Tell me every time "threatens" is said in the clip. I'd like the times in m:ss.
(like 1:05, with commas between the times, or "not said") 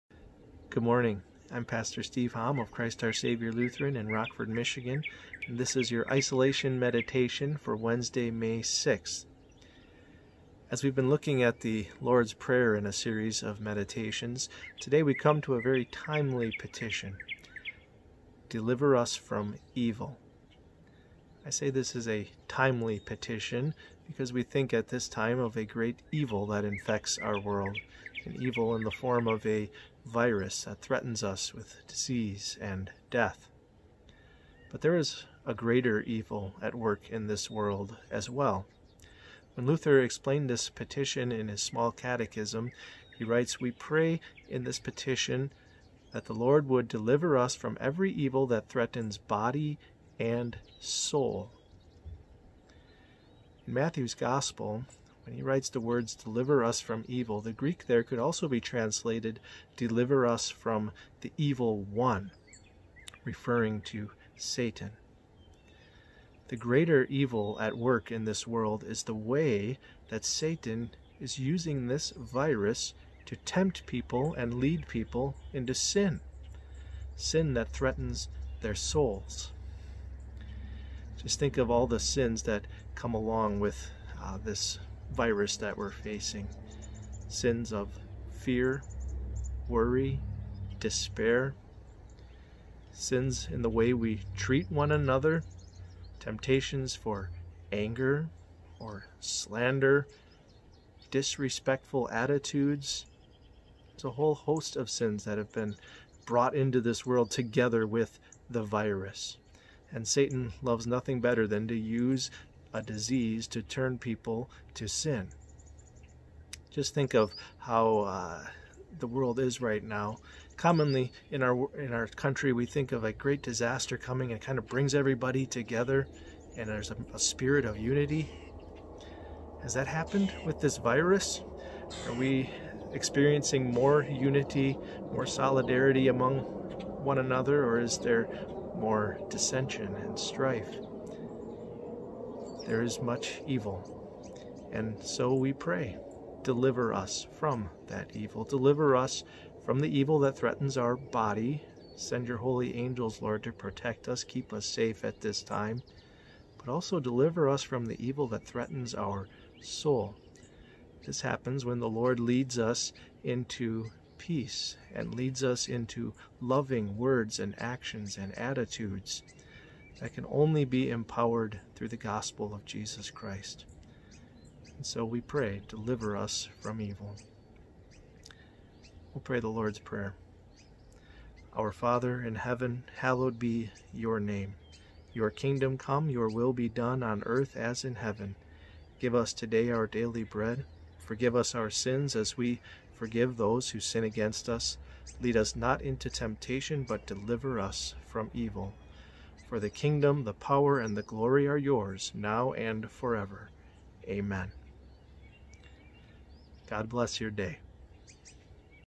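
0:30, 0:48, 1:17, 2:30, 2:38.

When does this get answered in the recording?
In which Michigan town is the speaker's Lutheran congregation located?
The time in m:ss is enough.
0:04.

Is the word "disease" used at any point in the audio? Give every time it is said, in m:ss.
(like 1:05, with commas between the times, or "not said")
0:31, 1:52.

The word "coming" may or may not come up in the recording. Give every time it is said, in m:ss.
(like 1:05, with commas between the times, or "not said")
2:03.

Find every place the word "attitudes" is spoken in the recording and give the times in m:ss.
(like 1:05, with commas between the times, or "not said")
1:42, 2:48.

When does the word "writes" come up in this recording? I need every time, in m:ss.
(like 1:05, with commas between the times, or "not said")
0:43, 0:55.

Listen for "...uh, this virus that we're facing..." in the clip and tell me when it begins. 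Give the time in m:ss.
1:24.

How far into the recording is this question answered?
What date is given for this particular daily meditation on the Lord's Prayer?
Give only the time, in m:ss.
0:07.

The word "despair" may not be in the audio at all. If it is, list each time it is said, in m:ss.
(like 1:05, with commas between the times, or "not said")
1:30.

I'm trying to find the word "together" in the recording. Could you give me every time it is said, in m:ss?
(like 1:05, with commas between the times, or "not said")
1:47, 2:05.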